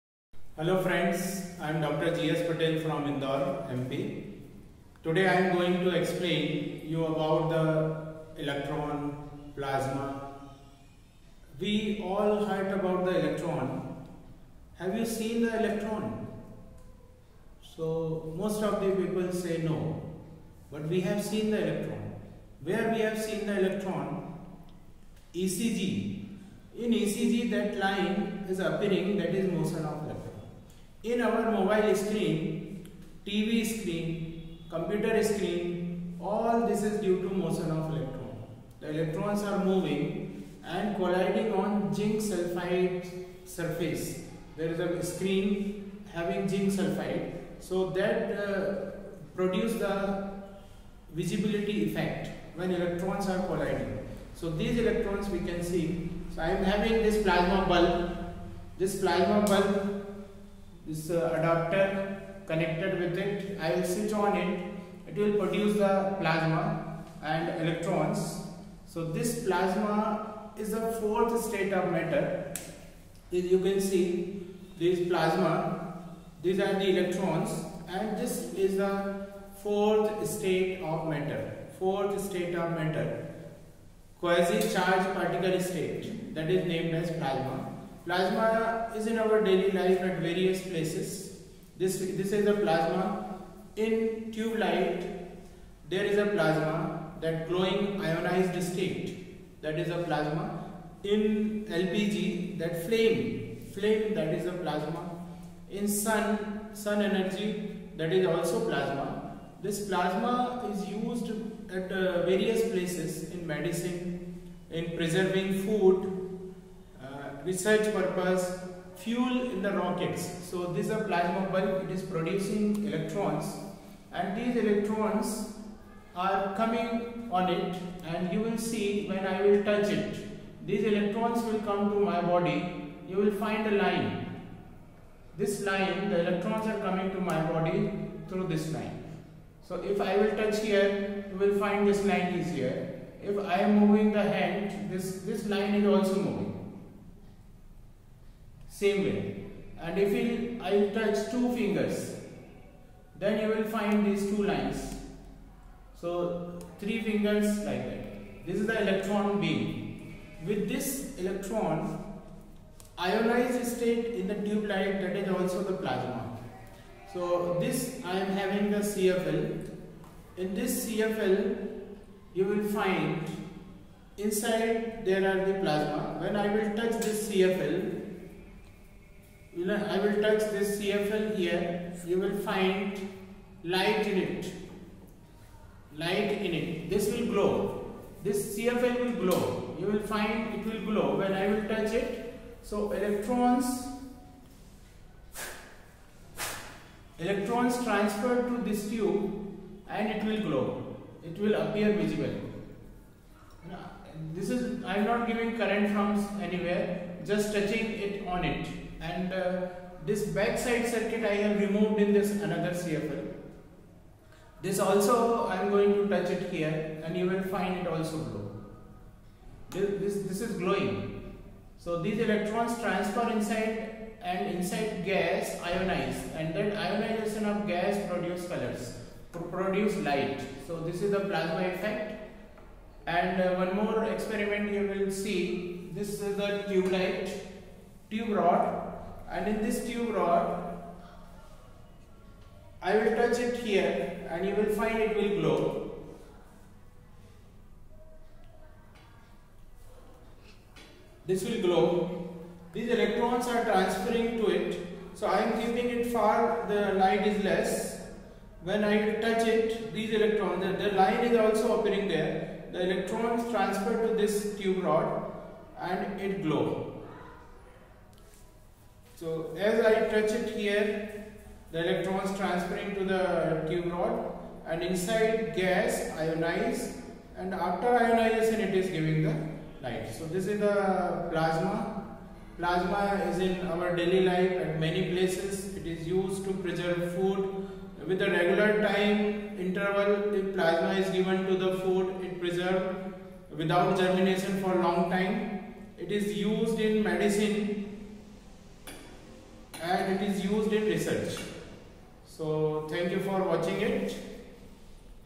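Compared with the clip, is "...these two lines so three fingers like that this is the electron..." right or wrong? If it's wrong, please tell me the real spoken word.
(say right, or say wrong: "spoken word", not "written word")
right.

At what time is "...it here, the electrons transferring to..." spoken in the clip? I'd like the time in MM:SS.
04:30.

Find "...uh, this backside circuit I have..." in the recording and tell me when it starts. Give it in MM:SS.
03:29.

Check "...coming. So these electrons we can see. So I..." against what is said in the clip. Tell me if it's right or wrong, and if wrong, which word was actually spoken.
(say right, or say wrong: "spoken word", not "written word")
wrong: "colliding", not "coming".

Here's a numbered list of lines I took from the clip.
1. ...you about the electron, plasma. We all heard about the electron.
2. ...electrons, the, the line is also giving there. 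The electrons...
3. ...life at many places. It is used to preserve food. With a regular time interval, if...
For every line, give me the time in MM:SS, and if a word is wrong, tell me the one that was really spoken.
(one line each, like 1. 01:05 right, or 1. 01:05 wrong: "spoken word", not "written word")
1. 00:06 right
2. 04:20 wrong: "appearing", not "giving"
3. 04:44 right.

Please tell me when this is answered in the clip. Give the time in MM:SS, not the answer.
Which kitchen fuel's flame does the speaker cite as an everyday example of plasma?
01:41.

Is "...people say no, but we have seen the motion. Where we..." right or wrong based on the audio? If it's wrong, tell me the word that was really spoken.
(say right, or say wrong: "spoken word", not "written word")
wrong: "electron", not "motion".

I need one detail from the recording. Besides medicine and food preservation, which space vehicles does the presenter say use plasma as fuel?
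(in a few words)
rockets.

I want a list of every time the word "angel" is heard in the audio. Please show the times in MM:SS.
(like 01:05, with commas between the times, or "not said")
not said.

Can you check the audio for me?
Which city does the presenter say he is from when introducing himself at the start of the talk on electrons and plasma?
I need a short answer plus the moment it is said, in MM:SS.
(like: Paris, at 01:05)
Indore, at 00:03.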